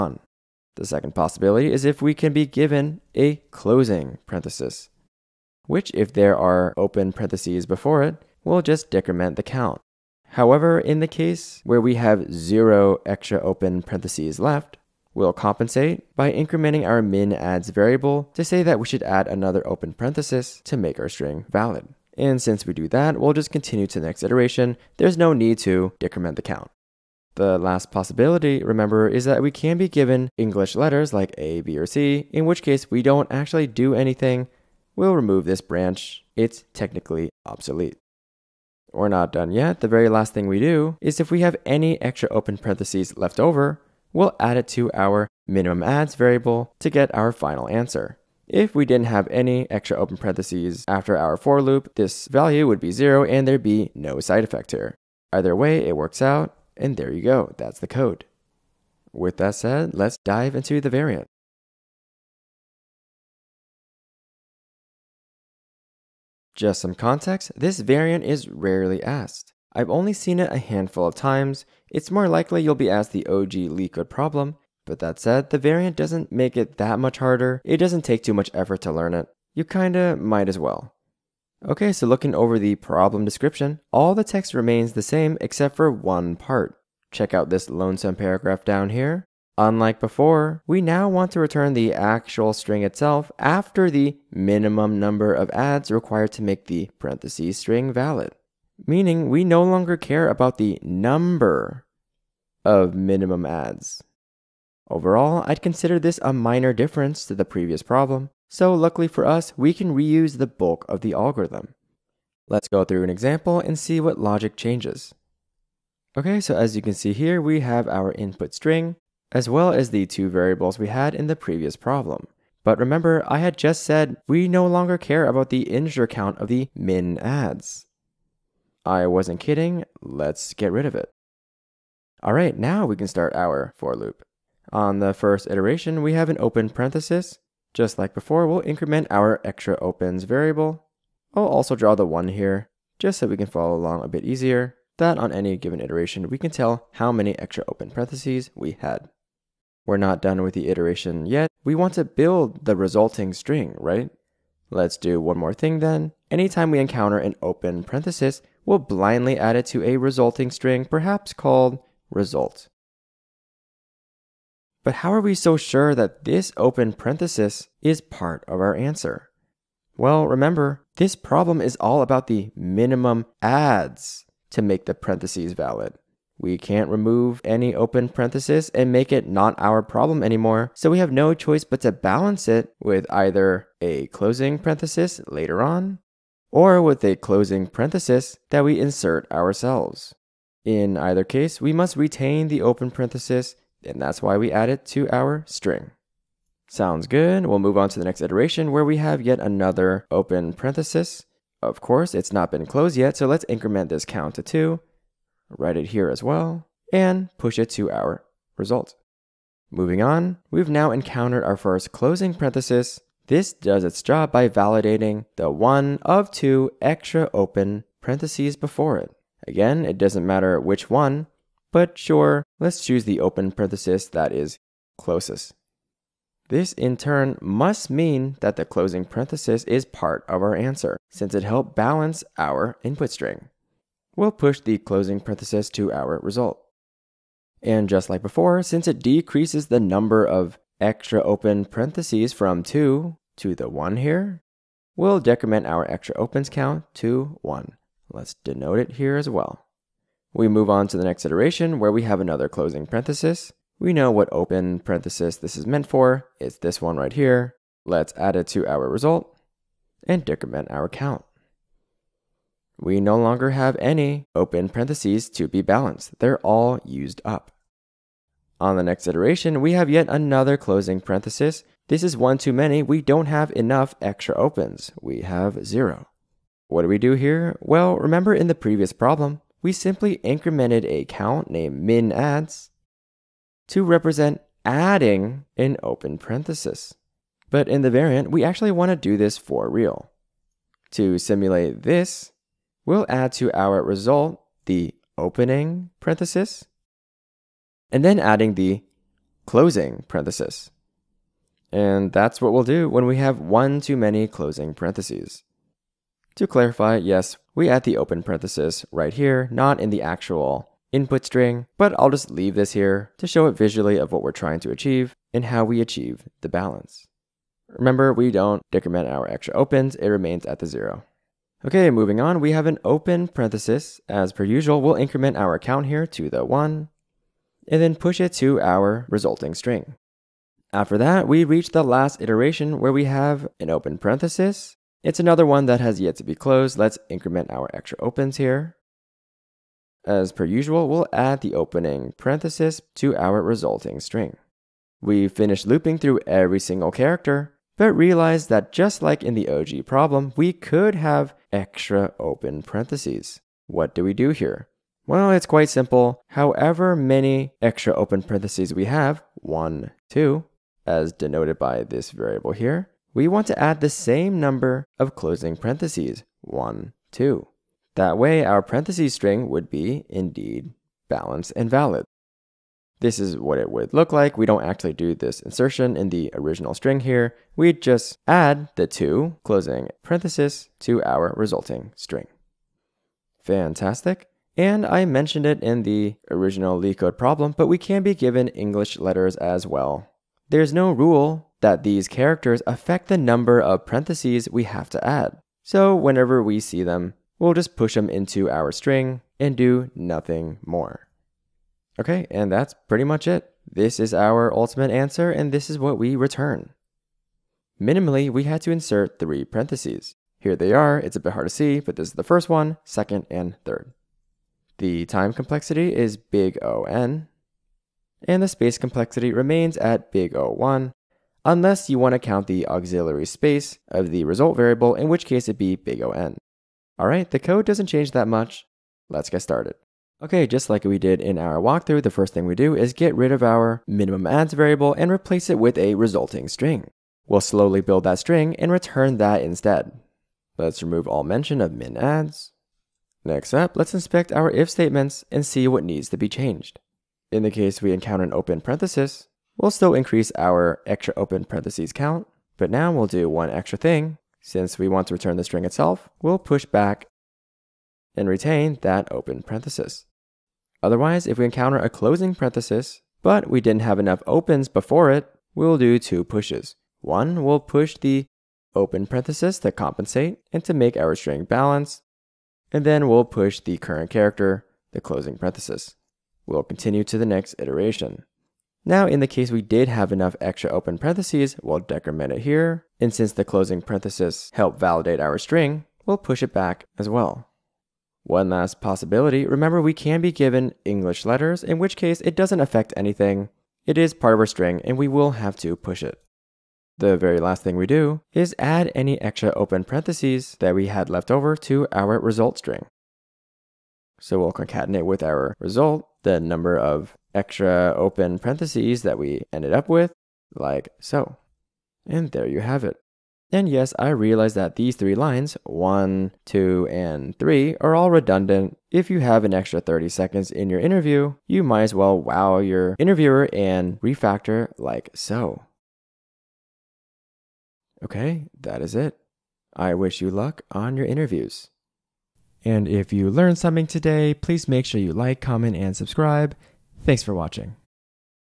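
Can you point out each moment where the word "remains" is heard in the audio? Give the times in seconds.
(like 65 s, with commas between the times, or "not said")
84 s, 320 s, 419 s.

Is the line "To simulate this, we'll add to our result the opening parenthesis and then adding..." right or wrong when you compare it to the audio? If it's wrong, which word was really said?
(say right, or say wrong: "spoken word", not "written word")
right.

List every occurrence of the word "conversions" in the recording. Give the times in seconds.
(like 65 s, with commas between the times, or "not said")
not said.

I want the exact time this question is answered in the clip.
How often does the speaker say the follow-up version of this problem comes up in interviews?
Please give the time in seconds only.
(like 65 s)
68 s.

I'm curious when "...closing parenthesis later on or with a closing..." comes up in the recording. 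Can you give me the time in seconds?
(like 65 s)
184 s.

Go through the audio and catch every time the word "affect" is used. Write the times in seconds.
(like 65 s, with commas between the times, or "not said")
392 s, 492 s.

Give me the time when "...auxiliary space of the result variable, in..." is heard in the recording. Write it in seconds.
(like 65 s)
422 s.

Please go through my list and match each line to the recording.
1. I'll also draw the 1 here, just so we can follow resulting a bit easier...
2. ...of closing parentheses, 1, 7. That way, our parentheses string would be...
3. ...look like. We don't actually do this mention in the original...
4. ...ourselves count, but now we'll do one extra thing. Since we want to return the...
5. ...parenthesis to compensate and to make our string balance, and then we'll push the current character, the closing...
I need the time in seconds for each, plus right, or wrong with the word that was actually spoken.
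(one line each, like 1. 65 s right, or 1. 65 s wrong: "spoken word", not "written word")
1. 141 s wrong: "along", not "resulting"
2. 364 s wrong: "2", not "7"
3. 373 s wrong: "insertion", not "mention"
4. 451 s wrong: "parentheses", not "ourselves"
5. 469 s right.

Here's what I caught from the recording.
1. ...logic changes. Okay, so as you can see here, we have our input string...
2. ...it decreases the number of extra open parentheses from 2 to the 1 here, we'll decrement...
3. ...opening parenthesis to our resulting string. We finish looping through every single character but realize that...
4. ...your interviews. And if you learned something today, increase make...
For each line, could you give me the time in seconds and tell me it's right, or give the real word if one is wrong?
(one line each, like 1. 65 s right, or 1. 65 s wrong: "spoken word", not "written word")
1. 114 s right
2. 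238 s right
3. 341 s right
4. 530 s wrong: "please", not "increase".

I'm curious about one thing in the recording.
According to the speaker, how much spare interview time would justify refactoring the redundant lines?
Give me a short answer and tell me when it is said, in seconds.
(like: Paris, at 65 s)
30 seconds, at 519 s.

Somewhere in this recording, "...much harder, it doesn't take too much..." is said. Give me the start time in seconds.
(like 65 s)
76 s.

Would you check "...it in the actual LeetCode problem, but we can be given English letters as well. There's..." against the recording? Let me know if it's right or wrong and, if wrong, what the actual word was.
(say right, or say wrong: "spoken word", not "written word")
wrong: "original", not "actual".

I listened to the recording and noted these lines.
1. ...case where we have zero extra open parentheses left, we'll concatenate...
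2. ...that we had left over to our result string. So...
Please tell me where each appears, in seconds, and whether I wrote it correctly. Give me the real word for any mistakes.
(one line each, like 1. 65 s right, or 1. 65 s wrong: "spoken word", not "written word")
1. 11 s wrong: "compensate", not "concatenate"
2. 500 s right.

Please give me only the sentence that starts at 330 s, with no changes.
After that, we reach the last iteration where we have an open parenthesis.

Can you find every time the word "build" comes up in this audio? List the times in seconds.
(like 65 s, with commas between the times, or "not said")
152 s, 437 s.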